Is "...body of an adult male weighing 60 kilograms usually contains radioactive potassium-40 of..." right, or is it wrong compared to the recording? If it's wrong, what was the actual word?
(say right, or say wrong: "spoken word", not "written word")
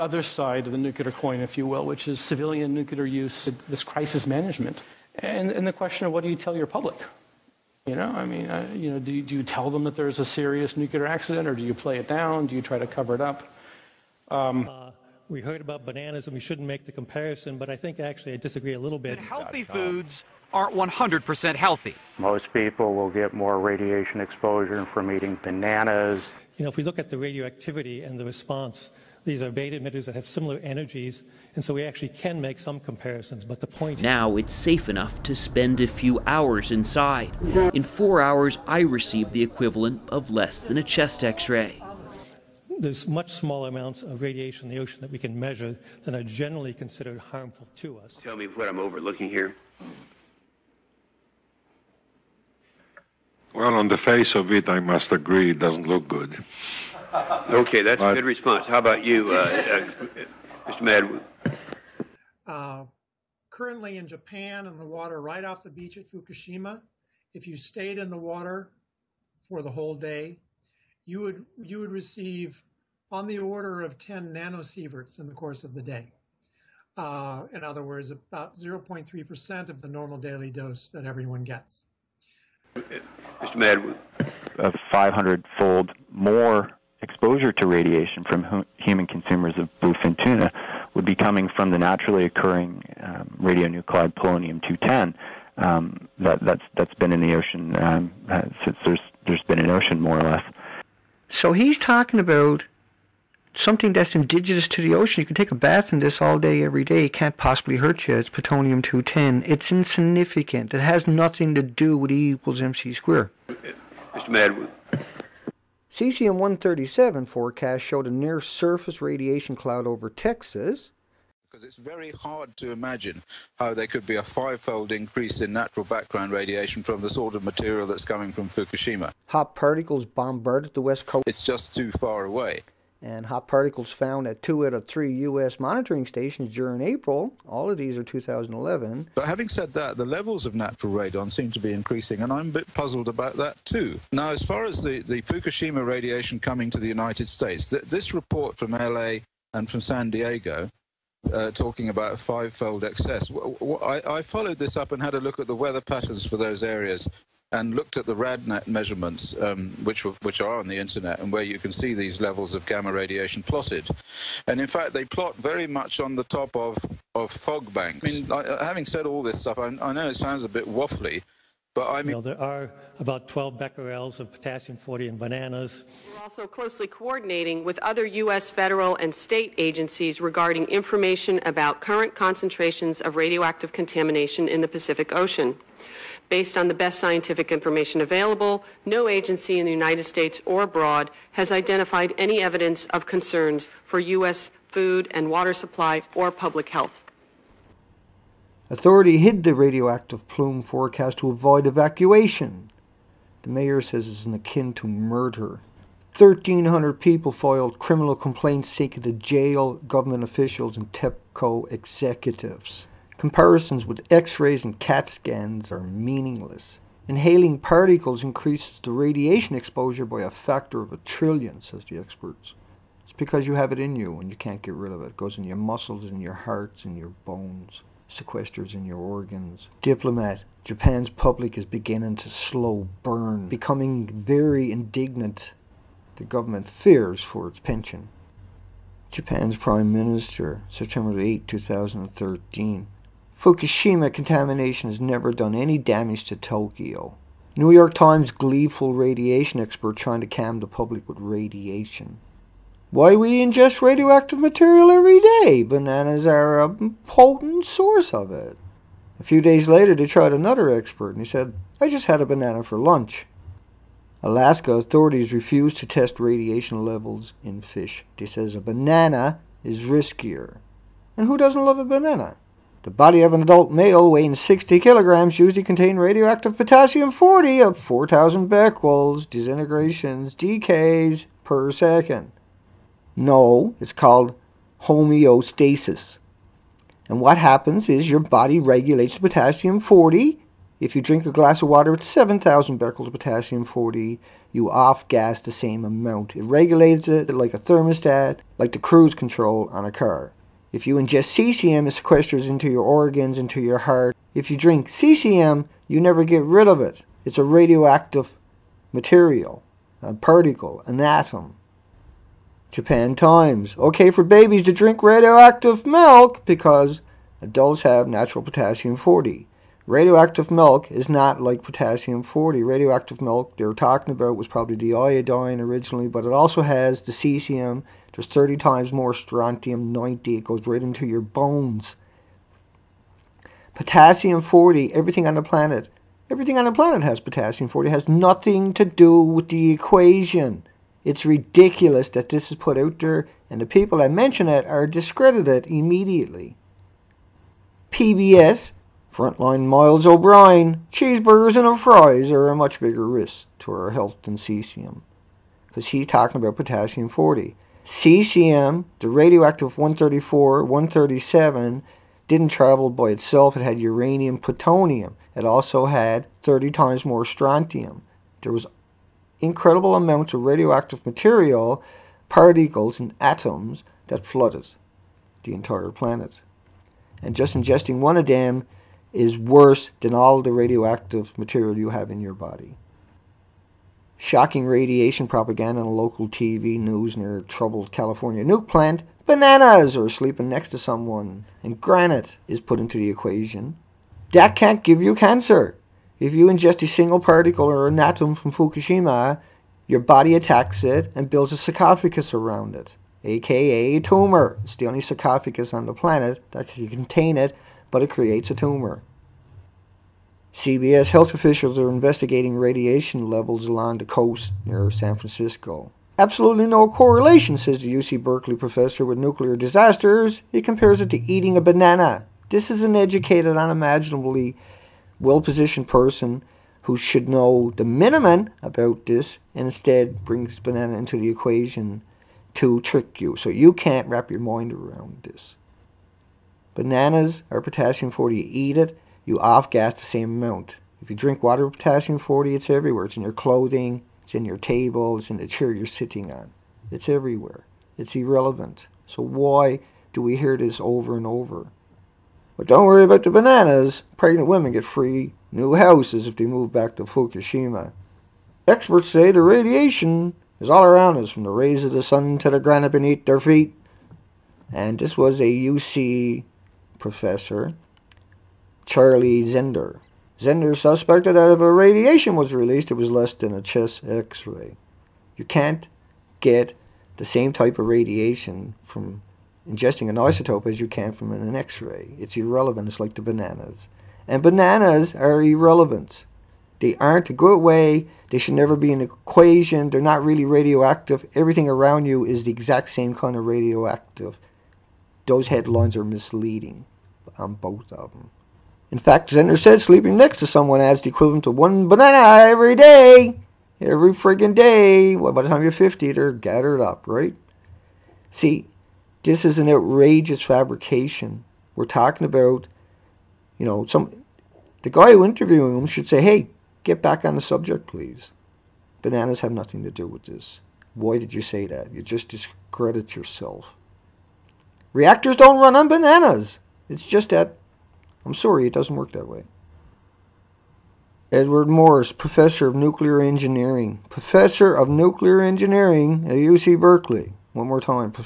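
right.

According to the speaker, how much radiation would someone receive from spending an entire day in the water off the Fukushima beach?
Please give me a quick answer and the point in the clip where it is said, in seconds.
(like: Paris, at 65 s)
10 nanosieverts, at 73 s.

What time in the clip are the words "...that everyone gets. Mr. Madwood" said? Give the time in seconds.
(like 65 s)
80 s.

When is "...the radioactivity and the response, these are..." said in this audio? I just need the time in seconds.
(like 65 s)
27 s.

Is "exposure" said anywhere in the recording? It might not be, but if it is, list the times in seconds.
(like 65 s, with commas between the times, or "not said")
24 s, 87 s, 219 s.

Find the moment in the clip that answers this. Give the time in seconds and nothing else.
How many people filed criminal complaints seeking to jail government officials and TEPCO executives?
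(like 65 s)
206 s.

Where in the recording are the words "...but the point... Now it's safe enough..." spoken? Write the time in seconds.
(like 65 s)
33 s.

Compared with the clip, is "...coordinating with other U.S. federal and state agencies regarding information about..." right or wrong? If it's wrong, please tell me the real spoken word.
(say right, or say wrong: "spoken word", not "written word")
right.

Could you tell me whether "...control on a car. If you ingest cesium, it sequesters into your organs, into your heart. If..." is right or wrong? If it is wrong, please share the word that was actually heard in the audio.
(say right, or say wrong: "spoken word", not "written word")
right.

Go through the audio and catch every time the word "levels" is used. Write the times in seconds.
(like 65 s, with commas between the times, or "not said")
140 s, 162 s, 266 s, 413 s.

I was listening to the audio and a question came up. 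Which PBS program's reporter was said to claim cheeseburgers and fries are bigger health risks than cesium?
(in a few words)
Frontline.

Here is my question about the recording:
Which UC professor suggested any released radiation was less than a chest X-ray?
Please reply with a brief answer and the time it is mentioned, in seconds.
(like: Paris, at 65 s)
Charlie Zender, at 468 s.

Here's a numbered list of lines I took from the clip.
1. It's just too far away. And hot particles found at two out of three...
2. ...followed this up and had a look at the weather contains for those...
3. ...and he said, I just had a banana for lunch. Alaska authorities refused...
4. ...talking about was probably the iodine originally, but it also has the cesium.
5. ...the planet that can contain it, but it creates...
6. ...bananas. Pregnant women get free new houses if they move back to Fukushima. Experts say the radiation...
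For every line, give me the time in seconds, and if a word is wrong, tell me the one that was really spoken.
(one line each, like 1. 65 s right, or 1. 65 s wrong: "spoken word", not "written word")
1. 131 s right
2. 154 s wrong: "patterns", not "contains"
3. 261 s right
4. 323 s right
5. 405 s right
6. 453 s right.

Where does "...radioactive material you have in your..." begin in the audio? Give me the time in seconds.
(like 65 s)
380 s.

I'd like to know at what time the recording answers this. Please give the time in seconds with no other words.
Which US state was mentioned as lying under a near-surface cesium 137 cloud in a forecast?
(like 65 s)
120 s.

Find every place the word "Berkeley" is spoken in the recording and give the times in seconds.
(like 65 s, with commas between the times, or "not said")
418 s, 536 s.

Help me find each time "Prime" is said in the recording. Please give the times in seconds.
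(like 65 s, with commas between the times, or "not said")
239 s.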